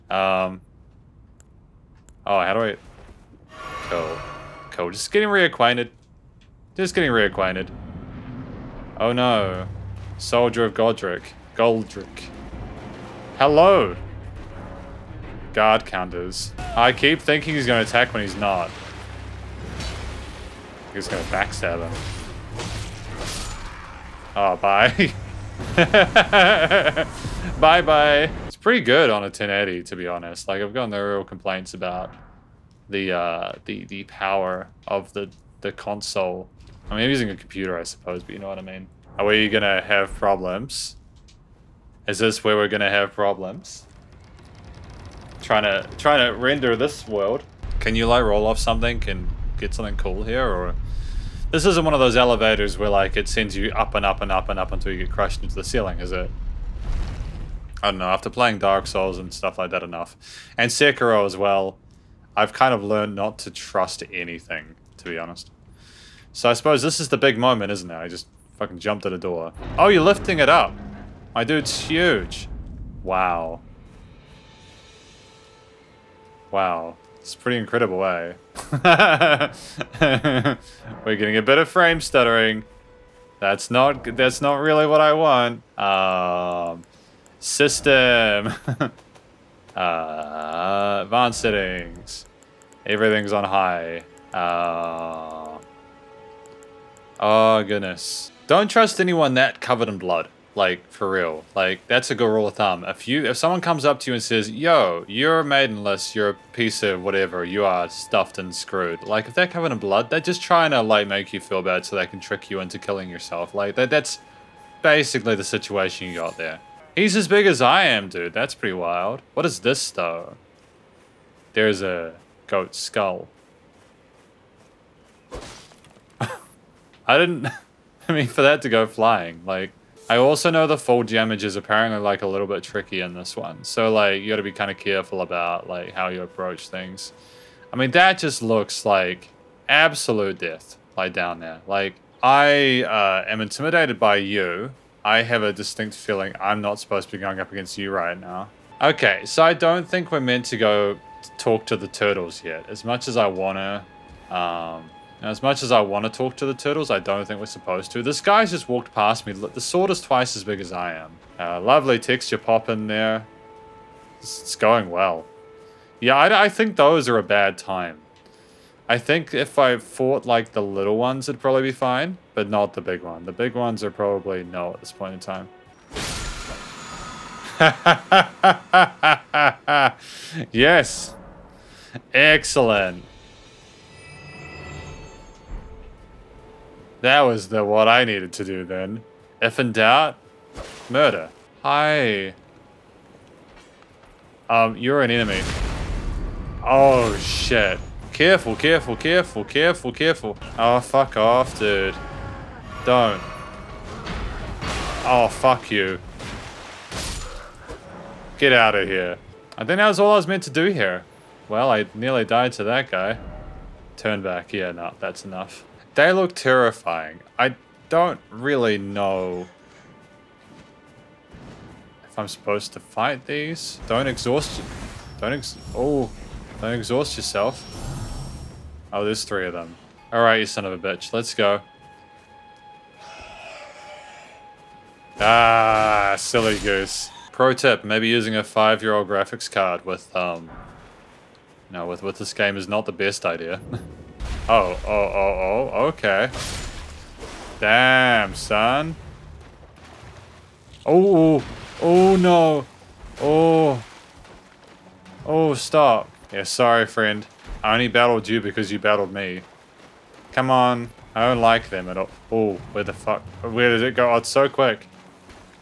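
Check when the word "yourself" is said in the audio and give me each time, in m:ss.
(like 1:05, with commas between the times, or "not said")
1:53, 3:47.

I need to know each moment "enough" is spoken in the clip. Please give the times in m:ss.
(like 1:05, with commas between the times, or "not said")
0:59, 3:35.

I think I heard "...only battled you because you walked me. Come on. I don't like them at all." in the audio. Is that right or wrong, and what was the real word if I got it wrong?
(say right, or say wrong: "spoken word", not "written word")
wrong: "battled", not "walked".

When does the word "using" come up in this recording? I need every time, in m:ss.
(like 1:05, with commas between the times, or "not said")
0:37, 3:58.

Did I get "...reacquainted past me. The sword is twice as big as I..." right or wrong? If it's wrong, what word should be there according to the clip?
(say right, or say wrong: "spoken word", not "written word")
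wrong: "walked", not "reacquainted".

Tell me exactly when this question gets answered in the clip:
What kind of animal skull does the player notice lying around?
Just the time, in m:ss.
2:02.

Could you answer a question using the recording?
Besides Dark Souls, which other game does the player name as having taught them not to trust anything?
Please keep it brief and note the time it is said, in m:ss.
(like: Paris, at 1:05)
Sekiro, at 1:00.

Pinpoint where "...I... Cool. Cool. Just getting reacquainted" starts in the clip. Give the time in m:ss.
0:02.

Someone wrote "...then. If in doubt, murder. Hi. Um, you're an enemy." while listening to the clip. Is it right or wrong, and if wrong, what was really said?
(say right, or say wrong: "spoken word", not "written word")
right.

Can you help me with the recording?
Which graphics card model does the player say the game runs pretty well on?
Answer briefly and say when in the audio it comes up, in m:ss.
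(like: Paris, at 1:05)
1080, at 0:29.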